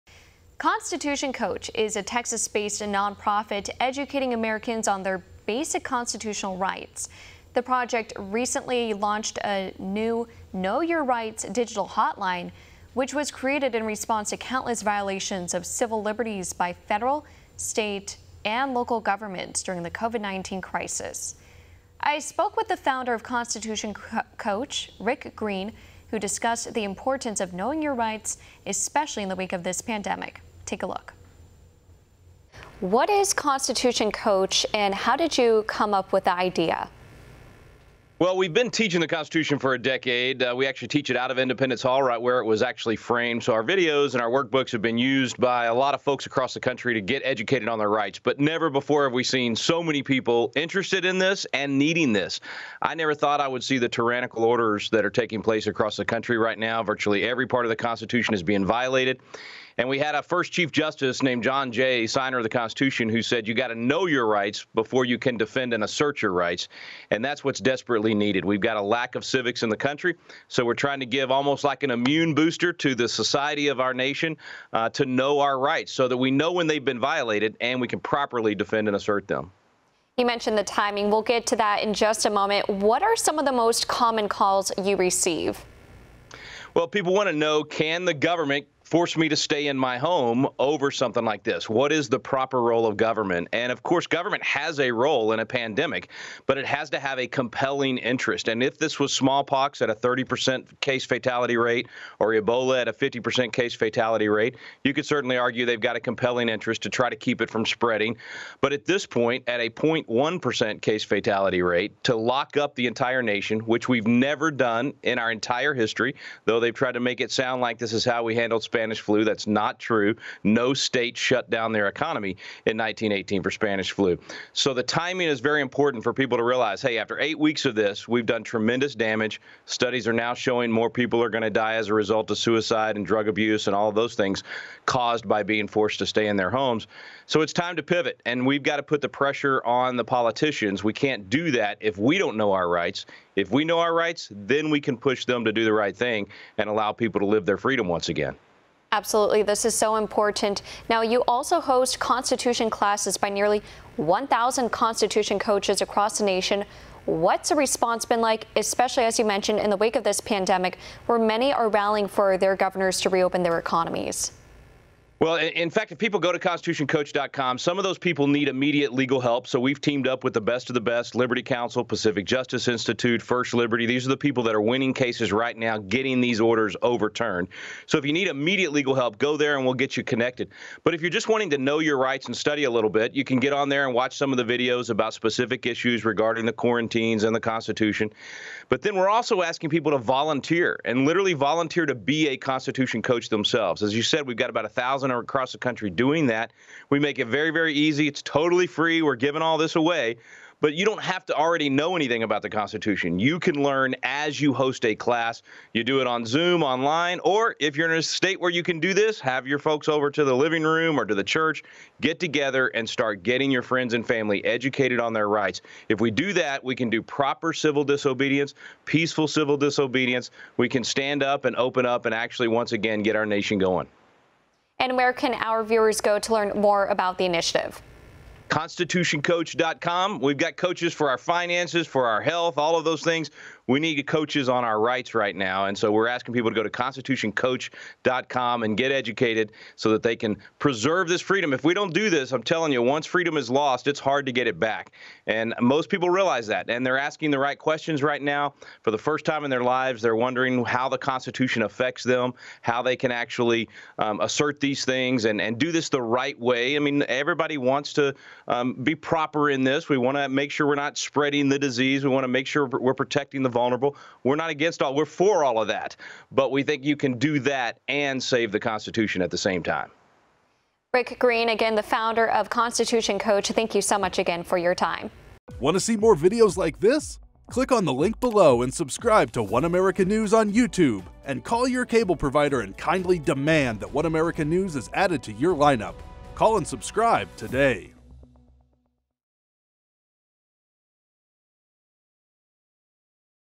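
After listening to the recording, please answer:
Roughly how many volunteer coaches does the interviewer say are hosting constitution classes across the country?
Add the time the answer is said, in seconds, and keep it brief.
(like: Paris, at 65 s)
1,000, at 153 s.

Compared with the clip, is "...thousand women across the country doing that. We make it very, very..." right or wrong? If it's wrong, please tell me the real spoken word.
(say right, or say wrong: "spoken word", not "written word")
right.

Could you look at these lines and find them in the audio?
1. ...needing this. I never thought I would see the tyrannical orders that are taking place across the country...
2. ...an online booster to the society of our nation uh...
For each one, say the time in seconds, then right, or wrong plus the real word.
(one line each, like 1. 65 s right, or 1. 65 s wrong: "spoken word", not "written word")
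1. 51 s right
2. 71 s wrong: "immune", not "online".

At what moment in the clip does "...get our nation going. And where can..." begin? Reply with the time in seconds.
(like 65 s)
223 s.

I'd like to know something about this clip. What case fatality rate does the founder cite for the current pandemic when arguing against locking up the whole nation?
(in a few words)
0.1%.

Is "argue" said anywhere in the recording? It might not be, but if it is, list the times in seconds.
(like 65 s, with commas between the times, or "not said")
105 s.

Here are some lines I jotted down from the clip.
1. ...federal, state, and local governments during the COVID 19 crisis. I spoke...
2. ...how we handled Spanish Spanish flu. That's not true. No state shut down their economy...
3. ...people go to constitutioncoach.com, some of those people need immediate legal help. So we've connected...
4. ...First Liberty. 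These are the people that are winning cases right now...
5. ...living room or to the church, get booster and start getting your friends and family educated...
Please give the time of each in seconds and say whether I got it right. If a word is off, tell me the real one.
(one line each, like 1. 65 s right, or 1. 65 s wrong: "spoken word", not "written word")
1. 16 s right
2. 118 s right
3. 165 s wrong: "teamed", not "connected"
4. 173 s right
5. 210 s wrong: "together", not "booster".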